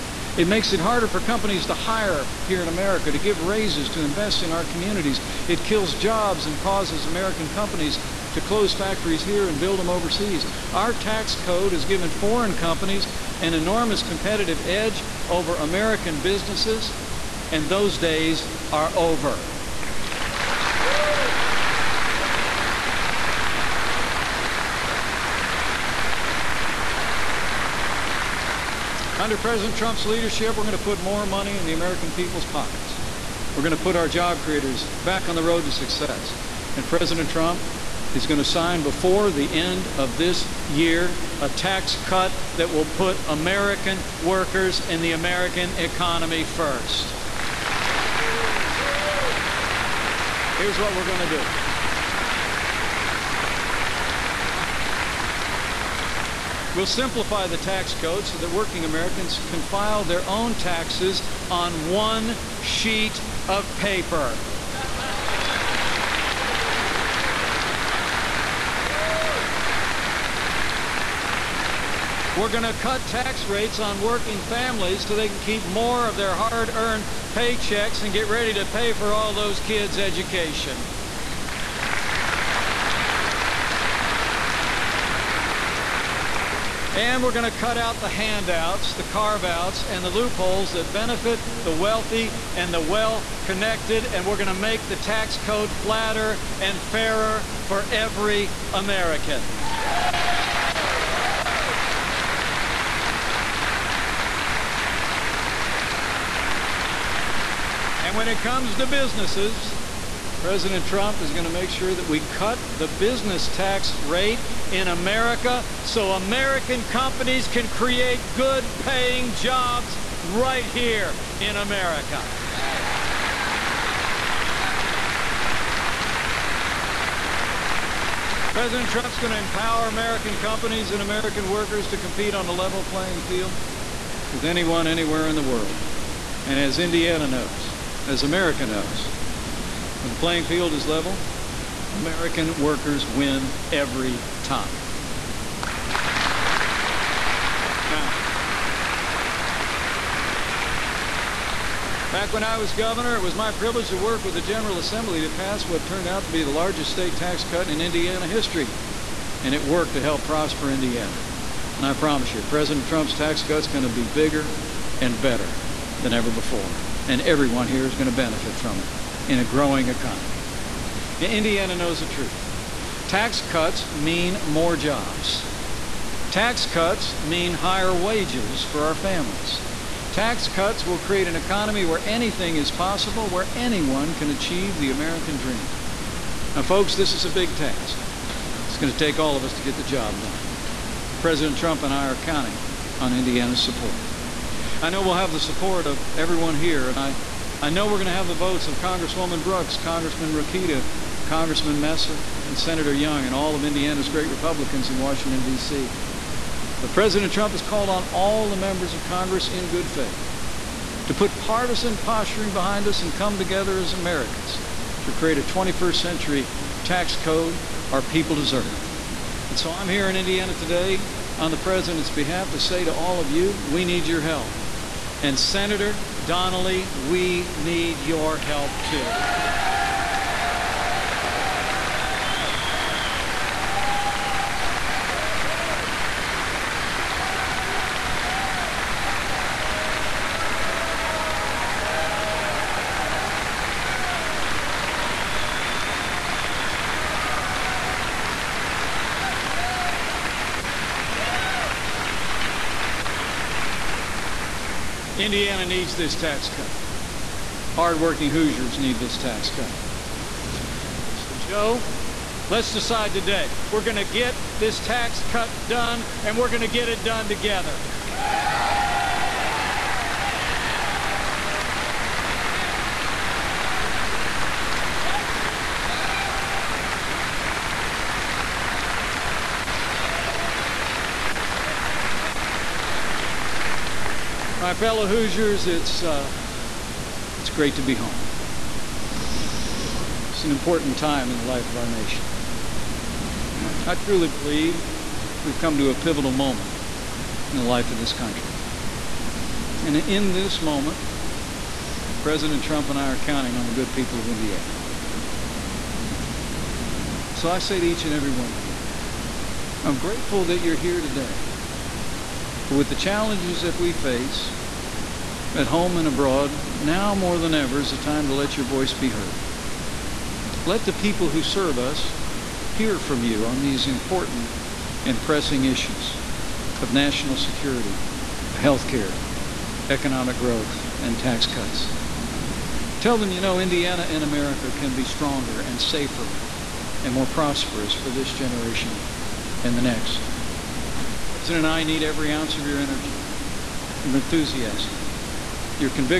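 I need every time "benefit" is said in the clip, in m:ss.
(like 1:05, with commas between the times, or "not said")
1:30, 2:48.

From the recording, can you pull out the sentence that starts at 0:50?
Here's what we're going to do.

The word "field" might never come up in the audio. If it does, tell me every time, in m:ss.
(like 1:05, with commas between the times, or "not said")
2:13, 2:20.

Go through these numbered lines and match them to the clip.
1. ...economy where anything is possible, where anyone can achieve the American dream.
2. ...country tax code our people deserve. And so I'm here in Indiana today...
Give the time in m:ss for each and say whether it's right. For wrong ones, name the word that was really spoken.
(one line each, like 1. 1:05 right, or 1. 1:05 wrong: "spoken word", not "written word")
1. 3:01 right
2. 3:36 wrong: "century", not "country".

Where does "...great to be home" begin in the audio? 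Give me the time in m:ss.
4:47.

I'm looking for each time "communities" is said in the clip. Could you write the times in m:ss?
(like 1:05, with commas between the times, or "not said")
0:04.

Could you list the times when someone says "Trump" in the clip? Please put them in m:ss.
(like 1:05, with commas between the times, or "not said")
0:29, 0:37, 1:50, 2:08, 2:42, 3:11, 3:27, 5:02.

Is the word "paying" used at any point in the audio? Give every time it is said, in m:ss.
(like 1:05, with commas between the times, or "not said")
1:58.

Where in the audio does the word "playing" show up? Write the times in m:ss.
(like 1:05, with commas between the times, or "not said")
2:12, 2:20.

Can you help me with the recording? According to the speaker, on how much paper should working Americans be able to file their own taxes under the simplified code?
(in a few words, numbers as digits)
one sheet of paper.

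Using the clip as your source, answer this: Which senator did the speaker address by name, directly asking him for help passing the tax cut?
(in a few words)
Senator Donnelly.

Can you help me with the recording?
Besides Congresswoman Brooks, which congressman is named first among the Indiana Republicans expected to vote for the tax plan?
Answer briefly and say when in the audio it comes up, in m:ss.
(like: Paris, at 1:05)
Congressman Rokita, at 3:19.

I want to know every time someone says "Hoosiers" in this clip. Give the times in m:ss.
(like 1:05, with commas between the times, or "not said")
4:18, 4:45.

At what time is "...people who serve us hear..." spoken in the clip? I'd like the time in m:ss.
5:20.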